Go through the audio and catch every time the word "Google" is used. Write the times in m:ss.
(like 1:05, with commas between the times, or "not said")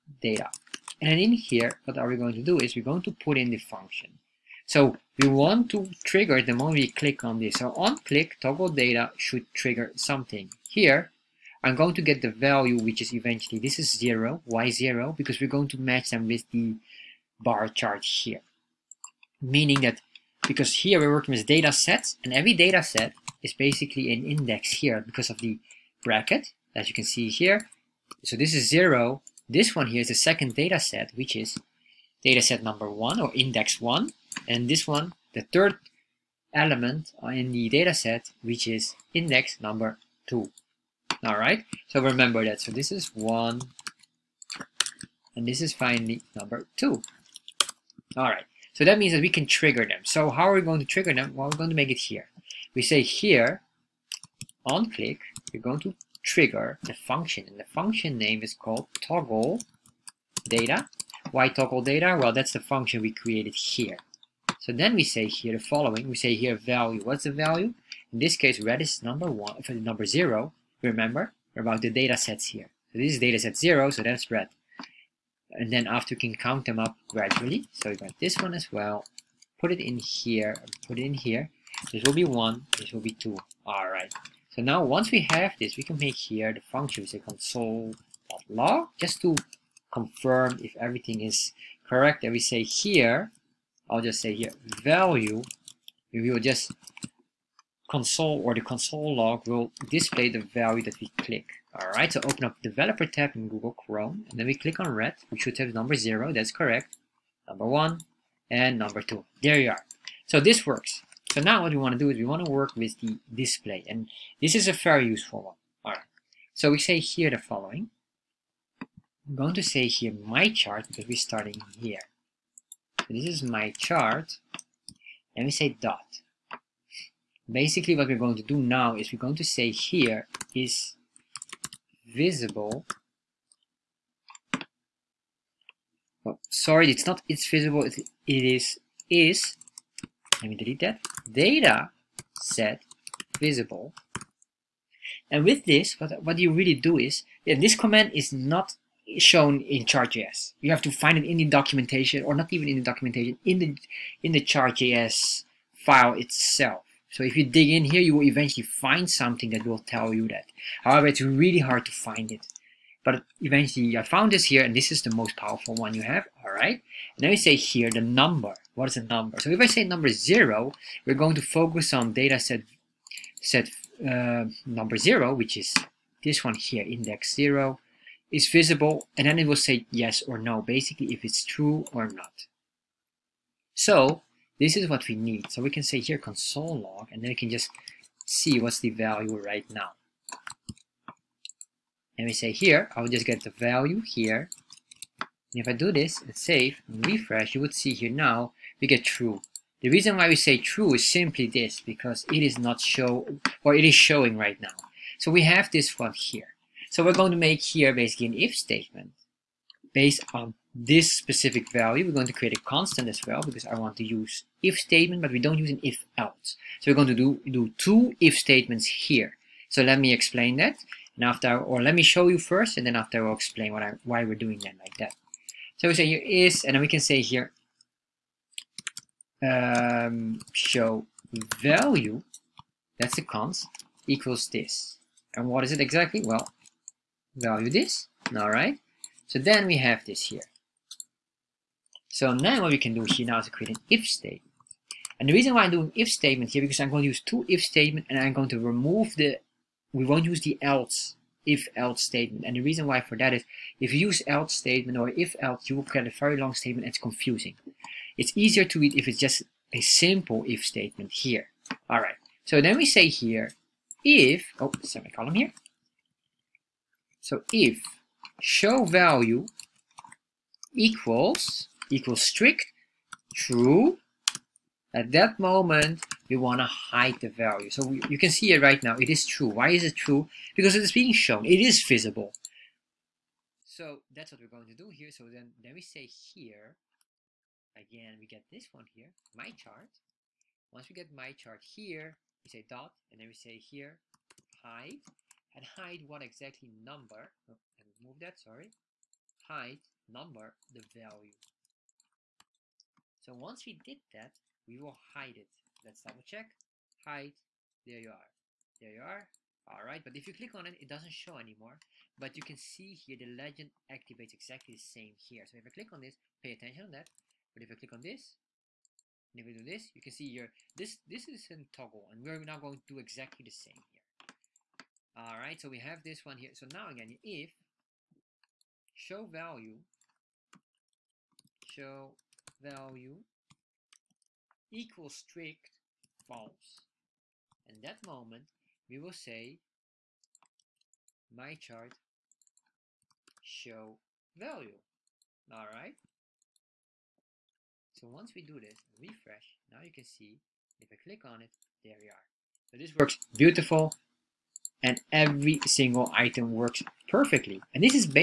1:43.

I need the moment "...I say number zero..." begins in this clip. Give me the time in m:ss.
2:49.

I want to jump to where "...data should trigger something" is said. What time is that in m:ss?
0:08.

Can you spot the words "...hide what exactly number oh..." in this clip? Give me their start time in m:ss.
4:55.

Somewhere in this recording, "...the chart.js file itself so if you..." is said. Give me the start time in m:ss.
2:34.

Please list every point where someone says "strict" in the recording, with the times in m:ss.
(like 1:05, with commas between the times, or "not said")
4:32, 5:35.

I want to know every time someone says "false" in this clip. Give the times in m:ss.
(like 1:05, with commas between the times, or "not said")
5:36.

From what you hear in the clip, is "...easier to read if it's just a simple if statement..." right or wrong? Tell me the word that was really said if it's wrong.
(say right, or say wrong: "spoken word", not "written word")
right.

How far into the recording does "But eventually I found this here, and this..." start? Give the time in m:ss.
2:43.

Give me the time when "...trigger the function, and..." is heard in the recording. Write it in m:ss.
0:56.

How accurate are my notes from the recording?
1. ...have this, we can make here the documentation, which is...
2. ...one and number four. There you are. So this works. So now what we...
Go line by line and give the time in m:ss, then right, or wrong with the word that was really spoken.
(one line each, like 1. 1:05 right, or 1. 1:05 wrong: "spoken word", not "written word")
1. 1:25 wrong: "function", not "documentation"
2. 1:47 wrong: "two", not "four".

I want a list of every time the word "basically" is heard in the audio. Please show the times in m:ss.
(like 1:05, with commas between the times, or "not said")
0:23, 2:07, 3:00, 3:27.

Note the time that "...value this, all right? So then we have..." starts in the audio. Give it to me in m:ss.
3:57.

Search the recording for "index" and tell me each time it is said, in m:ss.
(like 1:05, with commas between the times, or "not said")
0:24, 0:33, 0:39, 2:56.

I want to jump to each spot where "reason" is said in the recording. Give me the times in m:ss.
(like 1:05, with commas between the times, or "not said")
3:19, 4:05, 4:12.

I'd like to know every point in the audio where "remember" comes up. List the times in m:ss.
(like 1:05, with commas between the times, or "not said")
0:42, 1:10.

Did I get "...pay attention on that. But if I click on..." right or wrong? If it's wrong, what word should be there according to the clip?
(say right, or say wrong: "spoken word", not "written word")
right.